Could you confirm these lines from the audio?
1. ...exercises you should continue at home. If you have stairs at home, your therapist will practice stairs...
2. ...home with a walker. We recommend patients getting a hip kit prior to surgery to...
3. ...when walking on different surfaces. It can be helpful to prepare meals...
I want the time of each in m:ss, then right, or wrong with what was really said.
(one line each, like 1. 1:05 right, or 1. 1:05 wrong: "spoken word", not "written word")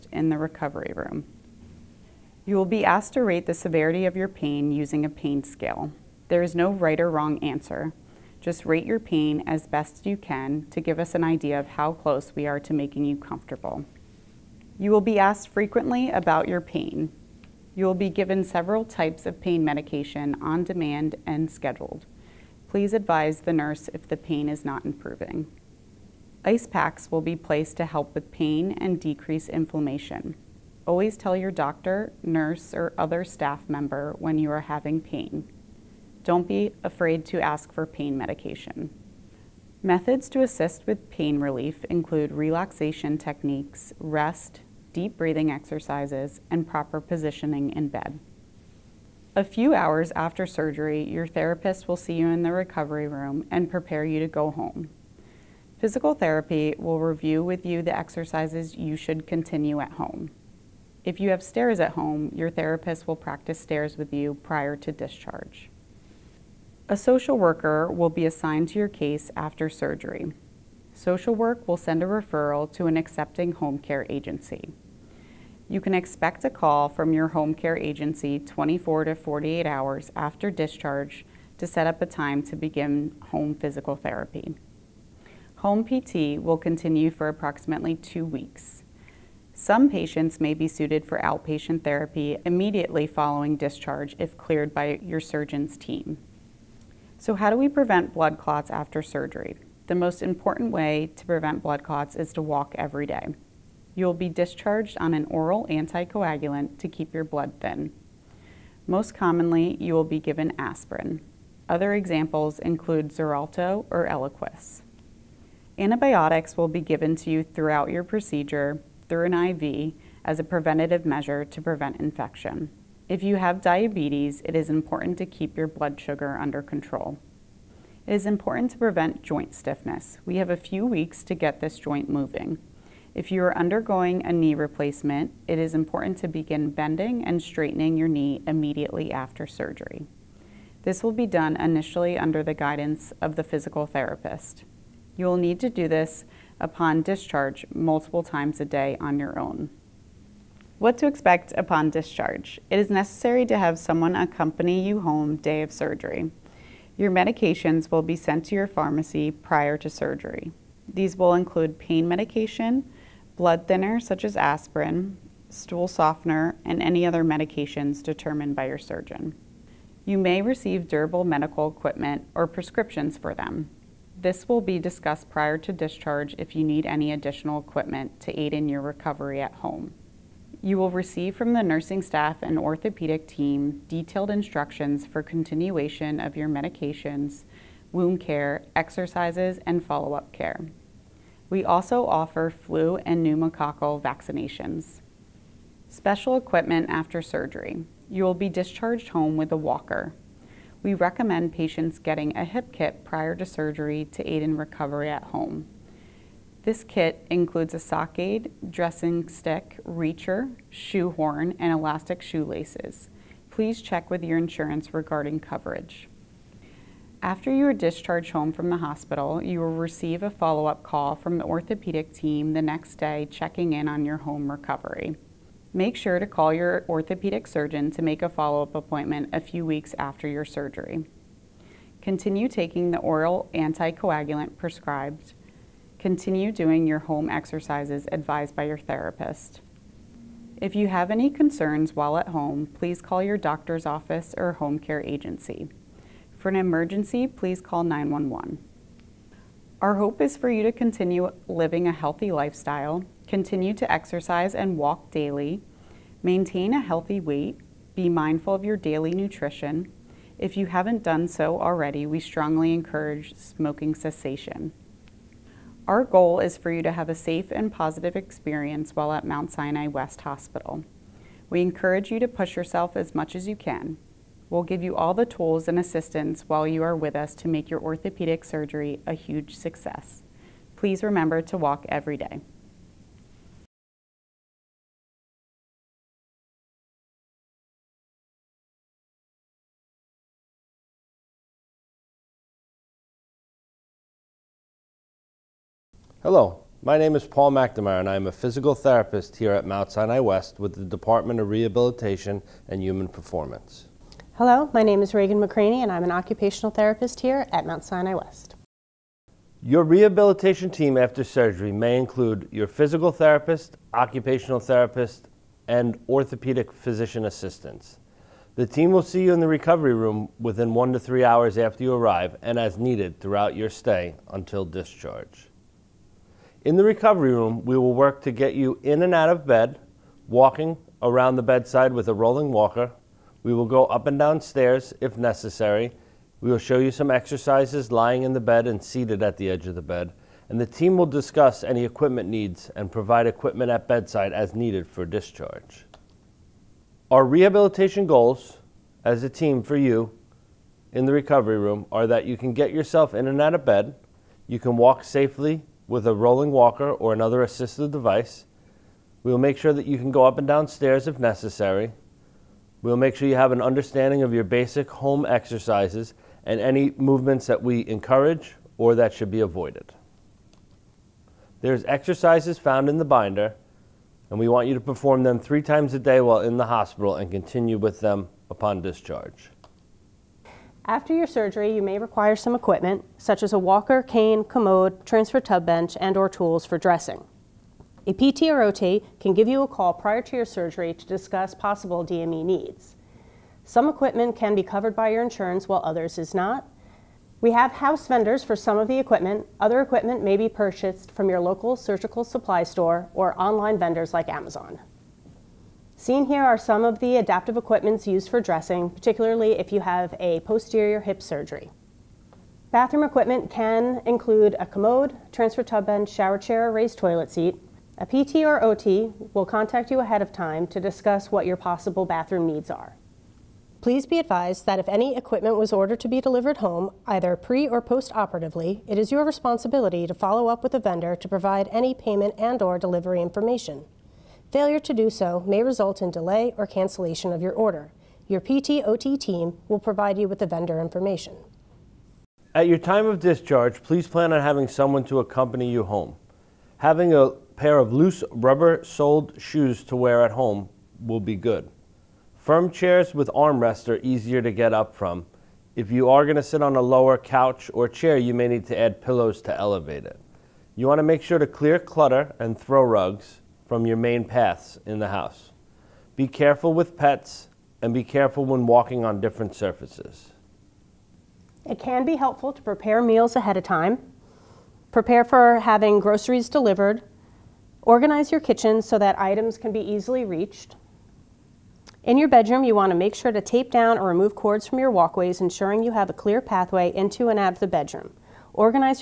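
1. 0:57 right
2. 3:19 right
3. 7:48 right.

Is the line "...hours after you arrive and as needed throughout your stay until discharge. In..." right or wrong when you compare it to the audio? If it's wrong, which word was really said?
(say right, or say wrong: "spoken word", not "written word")
right.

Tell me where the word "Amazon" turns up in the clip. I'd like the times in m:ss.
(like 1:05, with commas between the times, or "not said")
6:44.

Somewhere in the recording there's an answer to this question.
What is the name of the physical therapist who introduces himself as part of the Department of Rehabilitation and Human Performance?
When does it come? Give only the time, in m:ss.
4:57.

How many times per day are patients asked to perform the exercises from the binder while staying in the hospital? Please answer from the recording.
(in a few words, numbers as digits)
3.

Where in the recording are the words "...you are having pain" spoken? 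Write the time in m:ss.
0:34.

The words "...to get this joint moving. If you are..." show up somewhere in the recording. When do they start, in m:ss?
2:11.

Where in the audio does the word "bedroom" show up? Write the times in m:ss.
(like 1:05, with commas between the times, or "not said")
8:02, 8:07.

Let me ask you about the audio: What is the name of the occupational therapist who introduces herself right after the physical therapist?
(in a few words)
Reagan McCraney.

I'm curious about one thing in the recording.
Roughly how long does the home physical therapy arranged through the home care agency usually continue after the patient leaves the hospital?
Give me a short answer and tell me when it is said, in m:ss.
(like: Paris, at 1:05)
2 weeks, at 1:27.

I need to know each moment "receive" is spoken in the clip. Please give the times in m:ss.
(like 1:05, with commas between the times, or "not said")
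2:50, 3:00, 3:39.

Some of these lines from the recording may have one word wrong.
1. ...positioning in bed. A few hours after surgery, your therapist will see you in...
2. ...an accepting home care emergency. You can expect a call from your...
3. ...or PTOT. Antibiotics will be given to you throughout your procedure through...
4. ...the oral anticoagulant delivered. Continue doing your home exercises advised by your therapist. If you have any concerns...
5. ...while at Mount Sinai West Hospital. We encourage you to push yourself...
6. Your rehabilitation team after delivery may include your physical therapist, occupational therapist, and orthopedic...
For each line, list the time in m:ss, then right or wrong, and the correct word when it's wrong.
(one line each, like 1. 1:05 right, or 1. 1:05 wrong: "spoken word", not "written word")
1. 0:47 right
2. 1:12 wrong: "agency", not "emergency"
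3. 1:53 wrong: "Eliquis", not "PTOT"
4. 3:52 wrong: "prescribed", not "delivered"
5. 4:28 right
6. 5:09 wrong: "surgery", not "delivery".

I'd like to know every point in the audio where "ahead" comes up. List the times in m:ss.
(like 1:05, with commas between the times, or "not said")
6:59, 7:53.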